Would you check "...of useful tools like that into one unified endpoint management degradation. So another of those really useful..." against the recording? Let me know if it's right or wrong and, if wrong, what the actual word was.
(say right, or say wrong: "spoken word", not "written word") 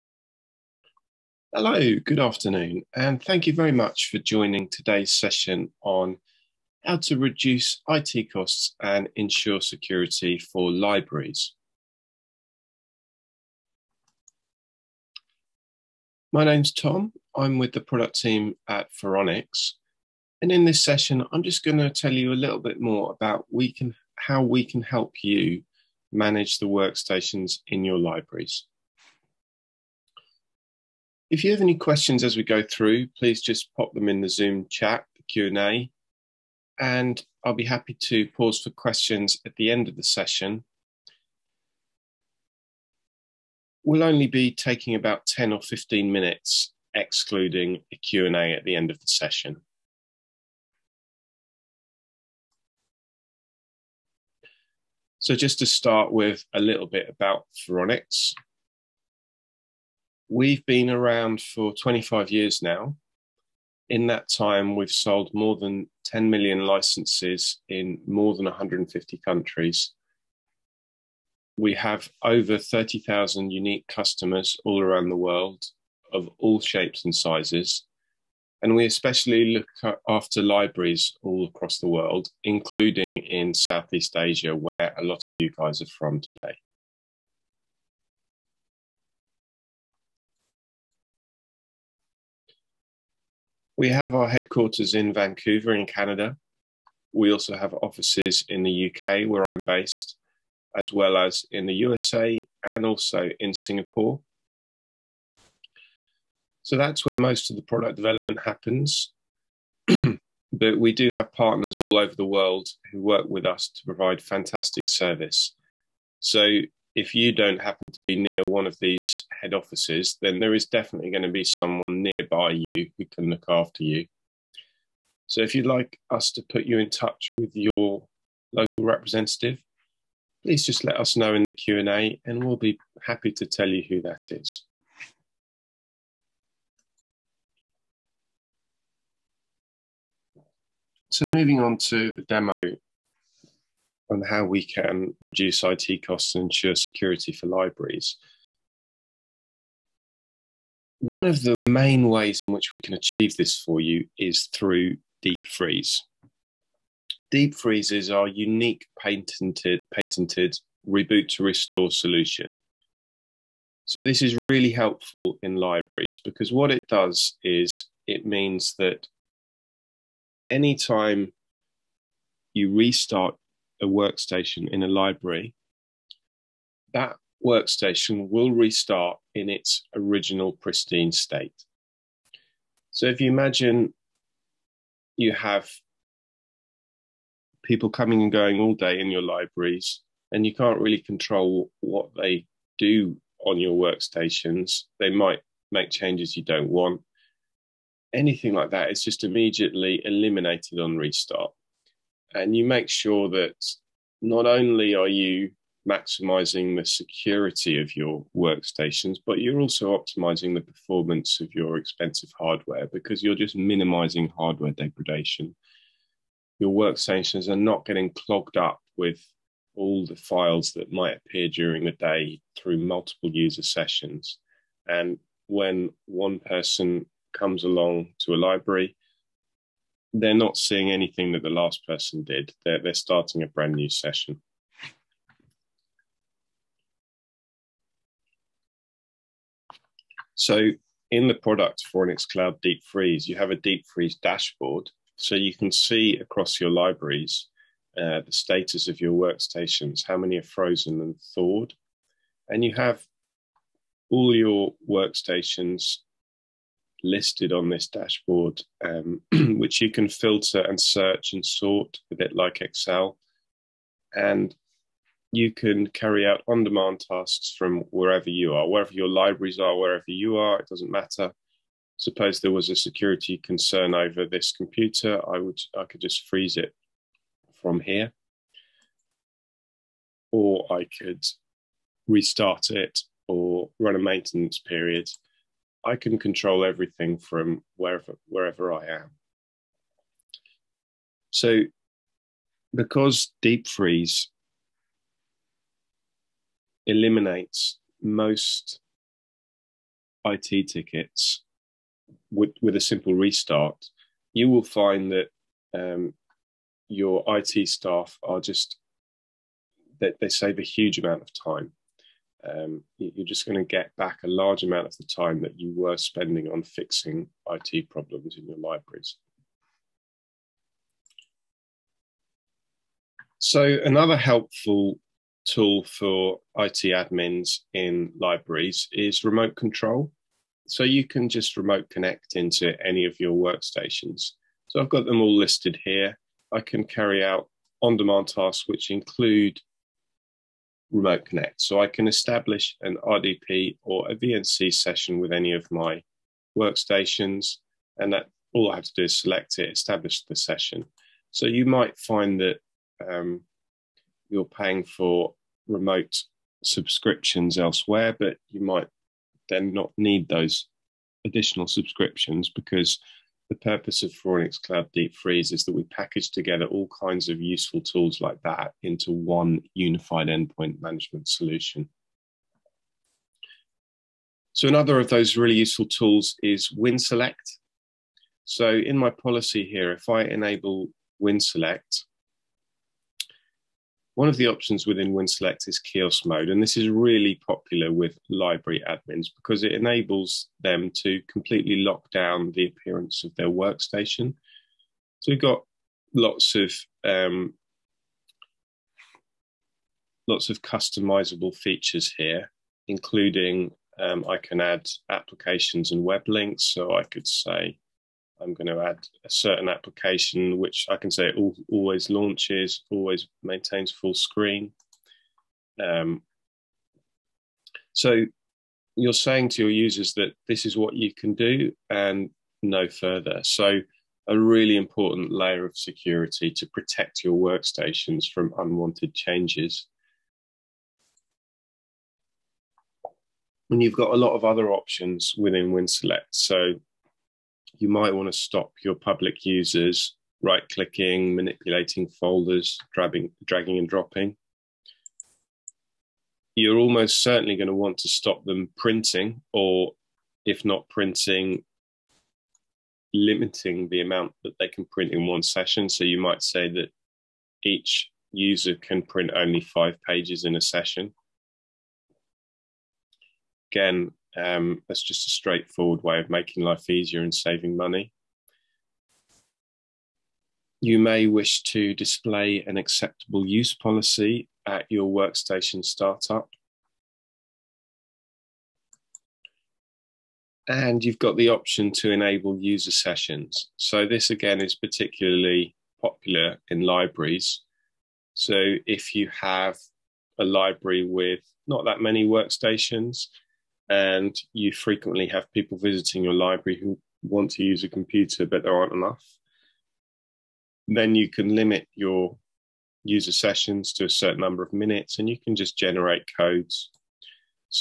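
wrong: "solution", not "degradation".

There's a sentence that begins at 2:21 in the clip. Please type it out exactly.
So moving on to the demo and how we can reduce IT costs and ensure security for libraries.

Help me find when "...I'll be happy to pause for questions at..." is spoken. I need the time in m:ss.
0:37.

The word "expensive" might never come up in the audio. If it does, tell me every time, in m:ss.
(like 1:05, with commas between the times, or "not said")
3:31.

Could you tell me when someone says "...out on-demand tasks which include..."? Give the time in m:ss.
5:37.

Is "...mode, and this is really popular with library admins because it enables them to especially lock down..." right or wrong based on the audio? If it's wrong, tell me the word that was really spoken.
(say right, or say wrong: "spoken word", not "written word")
wrong: "completely", not "especially".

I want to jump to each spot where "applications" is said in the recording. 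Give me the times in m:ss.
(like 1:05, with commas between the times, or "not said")
6:45, 6:49.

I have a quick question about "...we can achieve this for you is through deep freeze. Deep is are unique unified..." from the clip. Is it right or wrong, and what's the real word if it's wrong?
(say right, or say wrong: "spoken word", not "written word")
wrong: "patented", not "unified".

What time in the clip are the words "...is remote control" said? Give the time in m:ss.
5:28.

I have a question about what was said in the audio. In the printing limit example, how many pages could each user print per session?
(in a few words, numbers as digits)
5 pages.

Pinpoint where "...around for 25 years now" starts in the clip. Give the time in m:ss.
1:00.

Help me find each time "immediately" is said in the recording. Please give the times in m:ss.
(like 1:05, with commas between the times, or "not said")
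3:19.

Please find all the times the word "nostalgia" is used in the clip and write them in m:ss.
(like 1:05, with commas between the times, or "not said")
not said.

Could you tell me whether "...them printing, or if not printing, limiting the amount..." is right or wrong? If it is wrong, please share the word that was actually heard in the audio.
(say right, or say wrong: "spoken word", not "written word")
right.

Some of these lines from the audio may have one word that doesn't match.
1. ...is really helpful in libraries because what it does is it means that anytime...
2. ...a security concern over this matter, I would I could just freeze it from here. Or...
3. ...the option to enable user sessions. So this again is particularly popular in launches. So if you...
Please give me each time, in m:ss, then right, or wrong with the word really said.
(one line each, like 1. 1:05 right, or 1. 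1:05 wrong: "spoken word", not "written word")
1. 2:44 right
2. 4:32 wrong: "computer", not "matter"
3. 8:01 wrong: "libraries", not "launches".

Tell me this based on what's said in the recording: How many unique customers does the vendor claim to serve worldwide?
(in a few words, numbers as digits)
over 30,000.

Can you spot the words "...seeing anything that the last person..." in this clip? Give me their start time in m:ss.
3:50.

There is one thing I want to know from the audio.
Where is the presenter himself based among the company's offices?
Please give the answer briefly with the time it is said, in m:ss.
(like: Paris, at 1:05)
the UK, at 1:38.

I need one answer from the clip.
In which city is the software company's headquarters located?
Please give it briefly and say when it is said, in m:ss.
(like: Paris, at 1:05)
Vancouver, at 1:35.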